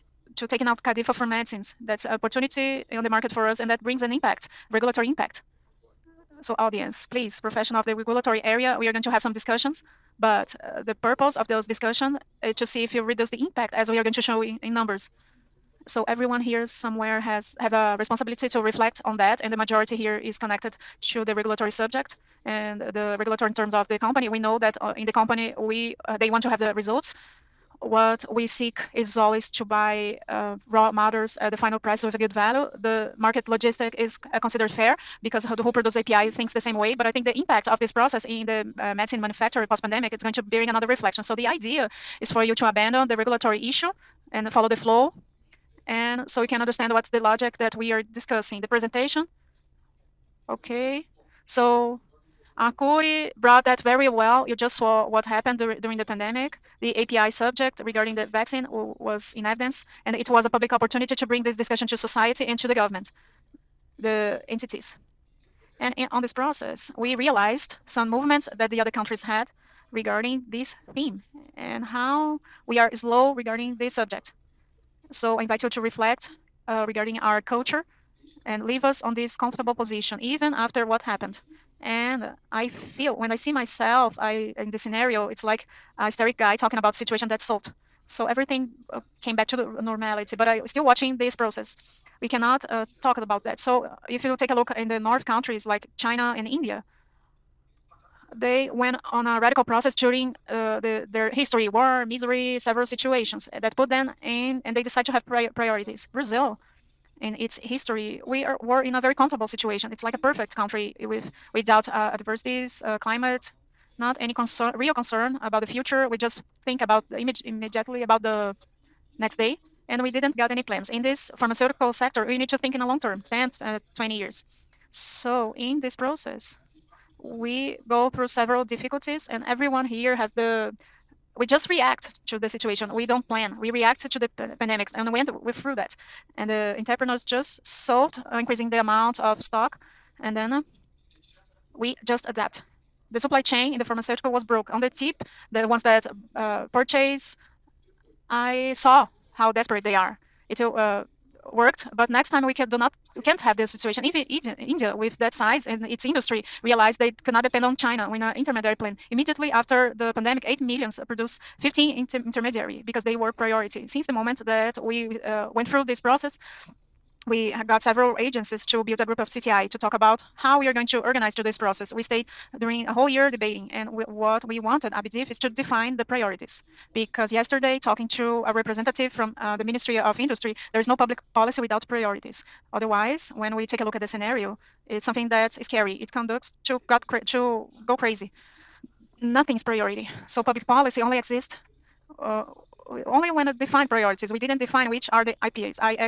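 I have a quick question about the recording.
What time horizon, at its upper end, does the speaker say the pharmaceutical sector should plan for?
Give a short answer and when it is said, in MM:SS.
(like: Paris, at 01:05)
20 years, at 02:03.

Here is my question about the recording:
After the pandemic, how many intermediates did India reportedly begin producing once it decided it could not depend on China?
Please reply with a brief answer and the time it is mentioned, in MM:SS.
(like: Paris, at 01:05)
15, at 02:41.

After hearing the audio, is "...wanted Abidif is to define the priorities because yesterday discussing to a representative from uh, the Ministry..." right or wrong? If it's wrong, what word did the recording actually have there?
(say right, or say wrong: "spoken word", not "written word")
wrong: "talking", not "discussing".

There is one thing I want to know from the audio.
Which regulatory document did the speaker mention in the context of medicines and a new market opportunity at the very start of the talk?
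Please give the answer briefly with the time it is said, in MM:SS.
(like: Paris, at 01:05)
CADIFA, at 00:00.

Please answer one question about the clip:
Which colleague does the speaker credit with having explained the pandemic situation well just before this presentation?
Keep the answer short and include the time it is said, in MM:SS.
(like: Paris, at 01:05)
Arcuri, at 00:52.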